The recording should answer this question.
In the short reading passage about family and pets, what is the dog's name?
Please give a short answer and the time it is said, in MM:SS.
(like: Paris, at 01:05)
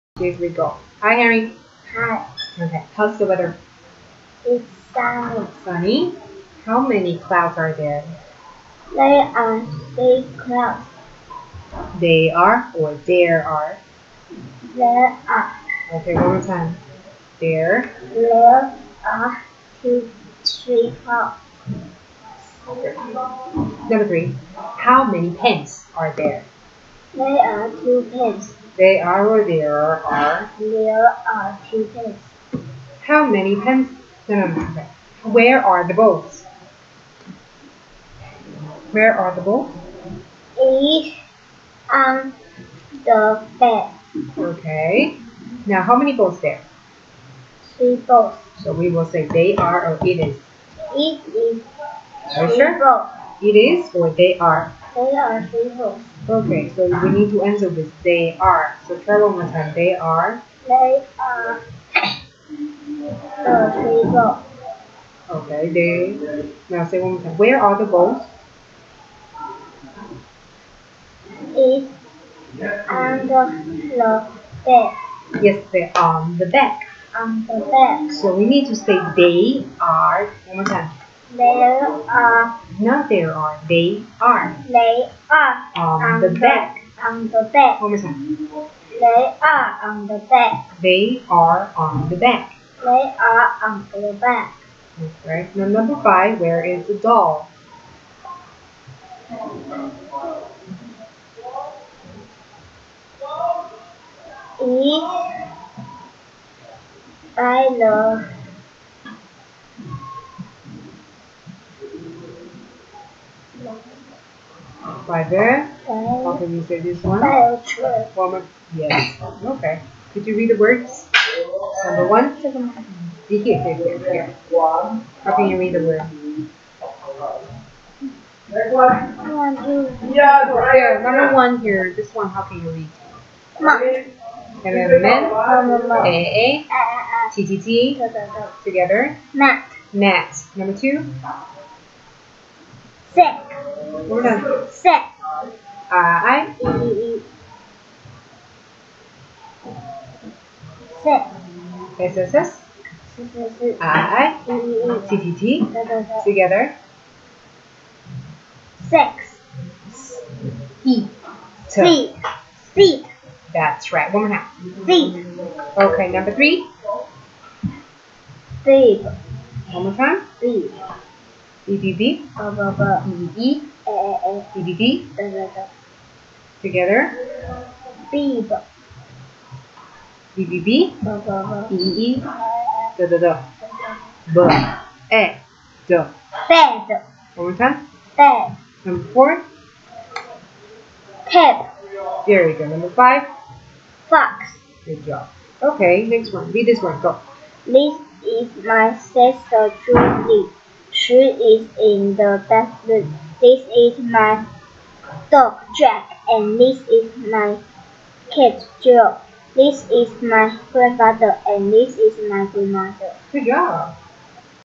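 Jack, at 03:25.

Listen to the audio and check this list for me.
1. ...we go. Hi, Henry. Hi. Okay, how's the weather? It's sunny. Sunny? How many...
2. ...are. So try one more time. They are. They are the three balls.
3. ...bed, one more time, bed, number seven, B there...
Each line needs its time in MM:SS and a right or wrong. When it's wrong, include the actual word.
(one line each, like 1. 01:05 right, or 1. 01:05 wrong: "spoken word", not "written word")
1. 00:00 right
2. 00:58 right
3. 03:05 wrong: "four", not "seven".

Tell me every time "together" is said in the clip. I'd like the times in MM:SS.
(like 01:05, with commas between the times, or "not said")
02:18, 02:36, 02:56.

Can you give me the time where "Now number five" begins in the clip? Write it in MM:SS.
01:35.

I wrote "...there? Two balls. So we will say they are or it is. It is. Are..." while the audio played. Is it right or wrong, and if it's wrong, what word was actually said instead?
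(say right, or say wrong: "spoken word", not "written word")
wrong: "Three", not "Two".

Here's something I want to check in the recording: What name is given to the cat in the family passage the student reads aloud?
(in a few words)
Joe.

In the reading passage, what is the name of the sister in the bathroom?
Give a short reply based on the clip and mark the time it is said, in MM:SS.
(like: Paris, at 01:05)
Julie, at 03:19.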